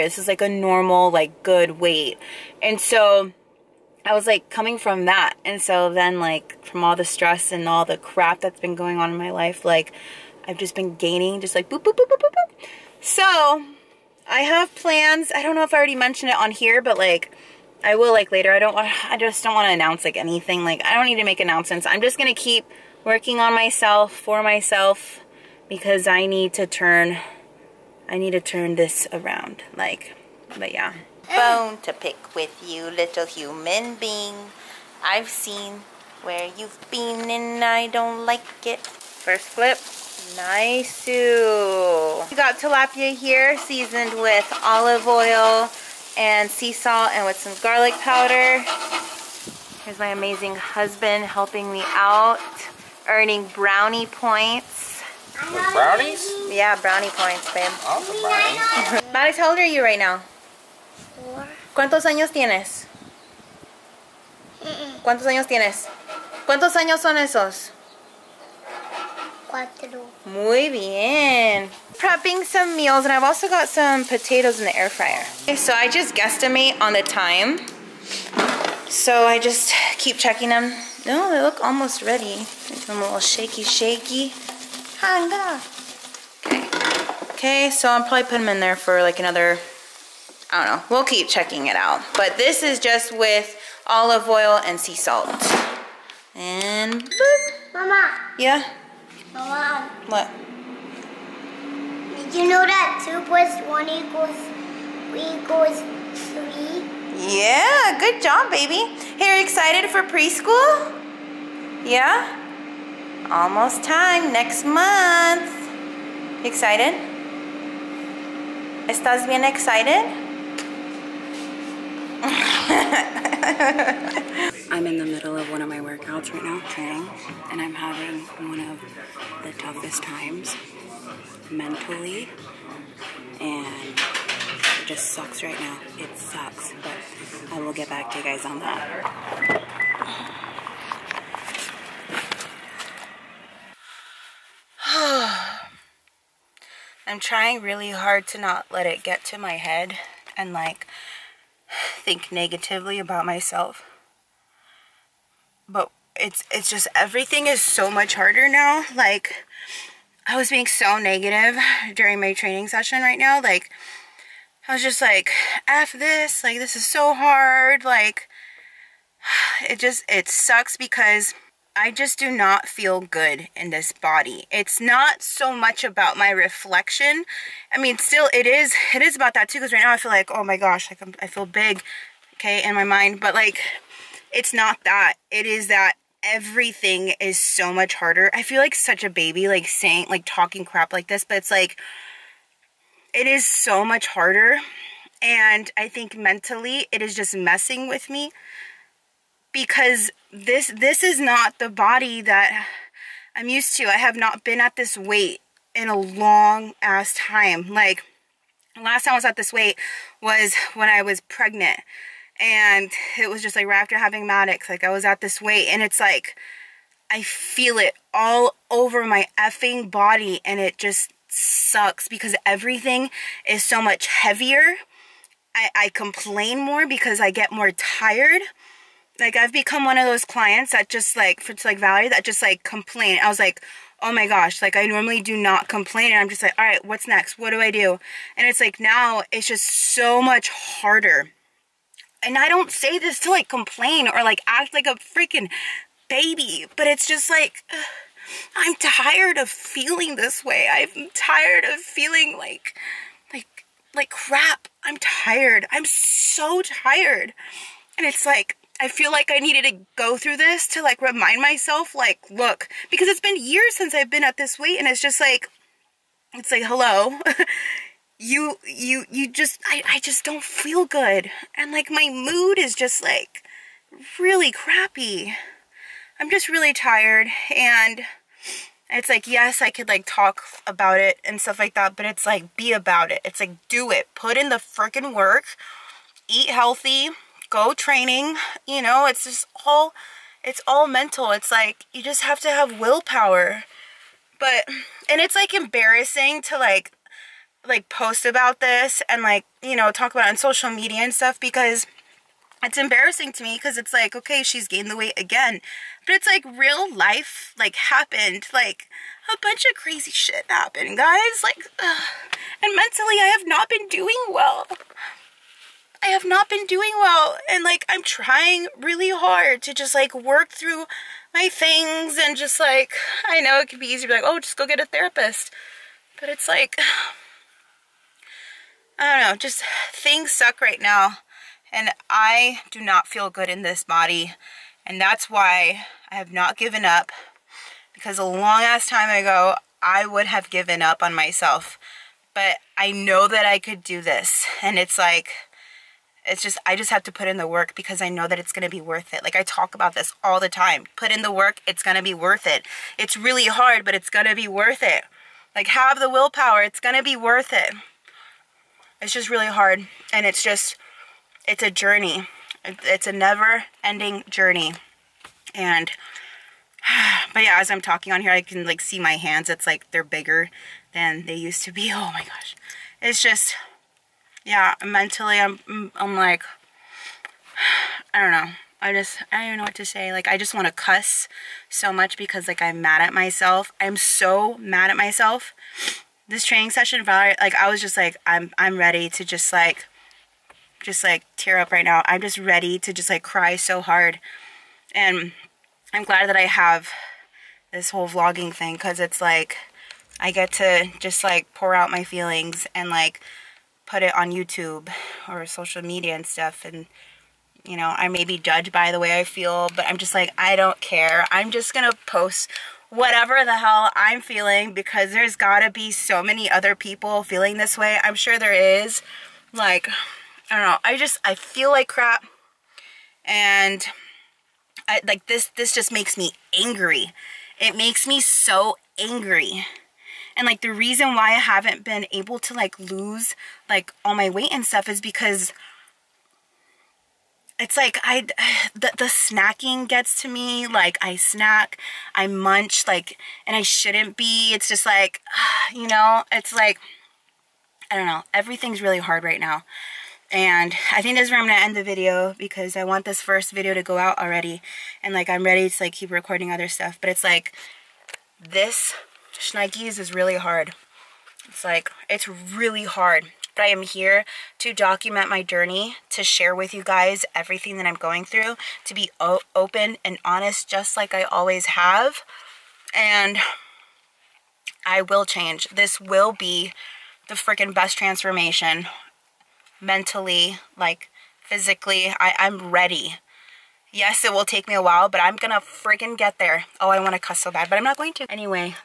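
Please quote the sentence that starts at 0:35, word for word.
I've seen where you've been and I don't like it.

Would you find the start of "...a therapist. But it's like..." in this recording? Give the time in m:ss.
5:24.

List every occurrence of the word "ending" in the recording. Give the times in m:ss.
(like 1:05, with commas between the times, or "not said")
6:03.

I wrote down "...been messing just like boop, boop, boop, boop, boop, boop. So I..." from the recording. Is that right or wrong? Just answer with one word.
wrong.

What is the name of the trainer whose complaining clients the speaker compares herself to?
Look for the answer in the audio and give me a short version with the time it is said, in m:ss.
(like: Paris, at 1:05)
Valerie, at 3:51.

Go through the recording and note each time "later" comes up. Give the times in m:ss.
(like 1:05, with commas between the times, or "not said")
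0:18.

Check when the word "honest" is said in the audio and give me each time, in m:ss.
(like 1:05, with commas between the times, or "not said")
7:50.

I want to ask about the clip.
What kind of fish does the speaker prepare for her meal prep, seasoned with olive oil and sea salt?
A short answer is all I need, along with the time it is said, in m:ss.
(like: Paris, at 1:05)
Tilapia, at 0:42.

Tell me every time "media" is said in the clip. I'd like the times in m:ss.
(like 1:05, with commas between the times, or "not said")
5:00, 6:45.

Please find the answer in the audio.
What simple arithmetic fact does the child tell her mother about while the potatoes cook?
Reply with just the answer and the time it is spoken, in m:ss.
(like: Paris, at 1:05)
2 plus 1 equals 3, at 1:43.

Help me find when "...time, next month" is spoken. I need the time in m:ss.
1:53.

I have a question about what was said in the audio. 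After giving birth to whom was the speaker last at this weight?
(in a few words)
Maddox.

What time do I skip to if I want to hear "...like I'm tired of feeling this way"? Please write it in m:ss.
4:07.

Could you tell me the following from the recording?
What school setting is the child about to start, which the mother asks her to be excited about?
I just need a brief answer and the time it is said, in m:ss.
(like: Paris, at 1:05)
Preschool, at 1:50.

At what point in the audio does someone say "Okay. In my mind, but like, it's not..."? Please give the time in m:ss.
3:02.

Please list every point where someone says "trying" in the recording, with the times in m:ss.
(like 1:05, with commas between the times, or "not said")
2:27, 5:18.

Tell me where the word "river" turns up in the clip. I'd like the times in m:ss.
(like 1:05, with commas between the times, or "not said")
not said.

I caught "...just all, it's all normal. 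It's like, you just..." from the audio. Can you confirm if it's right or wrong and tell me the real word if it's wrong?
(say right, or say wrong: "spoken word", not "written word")
wrong: "mental", not "normal".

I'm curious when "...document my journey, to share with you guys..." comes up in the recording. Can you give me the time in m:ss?
7:44.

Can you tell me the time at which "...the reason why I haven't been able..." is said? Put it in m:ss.
7:10.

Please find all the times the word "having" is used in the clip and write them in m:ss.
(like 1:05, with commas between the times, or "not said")
2:07, 3:33.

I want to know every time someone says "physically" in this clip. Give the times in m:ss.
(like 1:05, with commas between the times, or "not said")
8:01.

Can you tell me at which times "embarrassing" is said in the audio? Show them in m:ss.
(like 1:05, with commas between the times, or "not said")
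4:55, 5:02.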